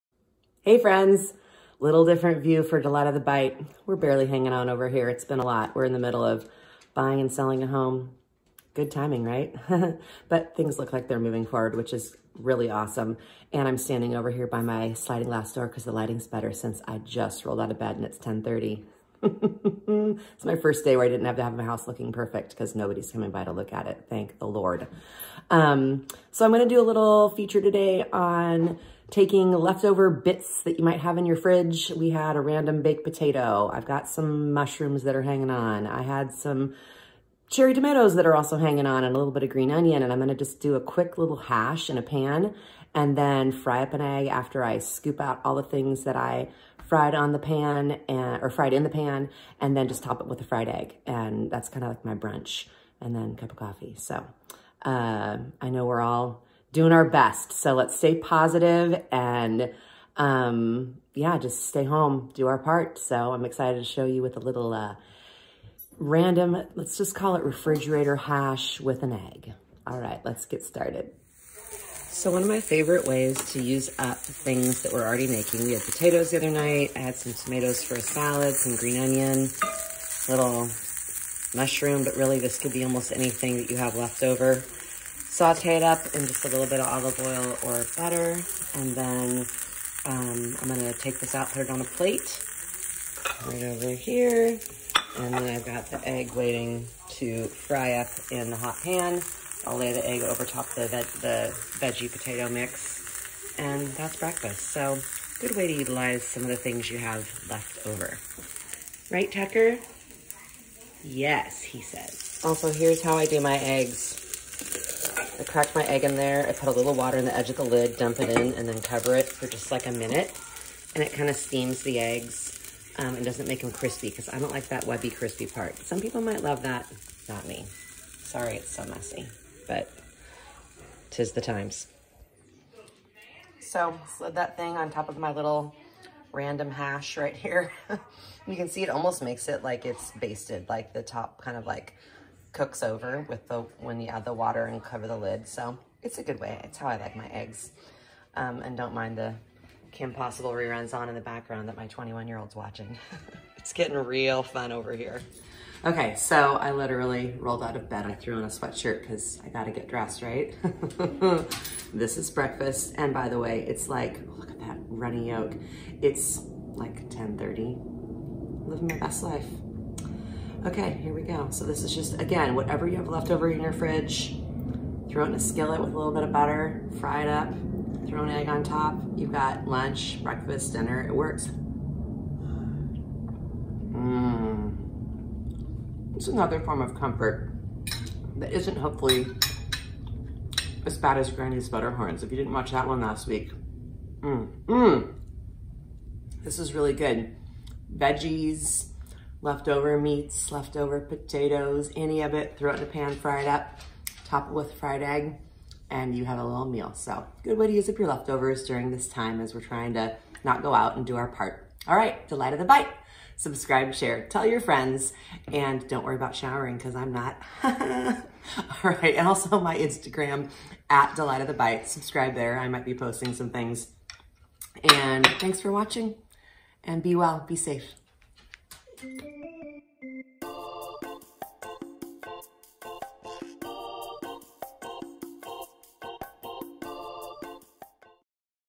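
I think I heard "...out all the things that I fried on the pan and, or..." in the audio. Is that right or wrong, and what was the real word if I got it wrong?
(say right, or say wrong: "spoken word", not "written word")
right.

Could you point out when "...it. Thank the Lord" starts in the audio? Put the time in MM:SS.
00:23.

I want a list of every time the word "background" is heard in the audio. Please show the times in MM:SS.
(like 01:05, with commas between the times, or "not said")
02:31.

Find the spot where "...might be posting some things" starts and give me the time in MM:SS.
03:42.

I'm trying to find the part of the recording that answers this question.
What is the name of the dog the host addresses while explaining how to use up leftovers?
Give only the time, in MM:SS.
01:49.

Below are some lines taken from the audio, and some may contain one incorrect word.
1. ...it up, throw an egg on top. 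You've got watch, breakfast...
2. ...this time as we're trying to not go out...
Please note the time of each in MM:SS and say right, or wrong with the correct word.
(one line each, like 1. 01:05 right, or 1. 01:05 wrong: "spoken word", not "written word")
1. 02:57 wrong: "lunch", not "watch"
2. 03:28 right.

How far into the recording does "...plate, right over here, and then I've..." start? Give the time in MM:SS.
01:31.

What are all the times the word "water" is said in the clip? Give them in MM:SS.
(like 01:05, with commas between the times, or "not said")
01:56, 02:24.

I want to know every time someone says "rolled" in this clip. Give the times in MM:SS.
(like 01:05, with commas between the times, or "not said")
00:17, 02:37.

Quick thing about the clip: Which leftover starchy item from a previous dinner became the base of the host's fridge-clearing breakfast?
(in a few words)
baked potato.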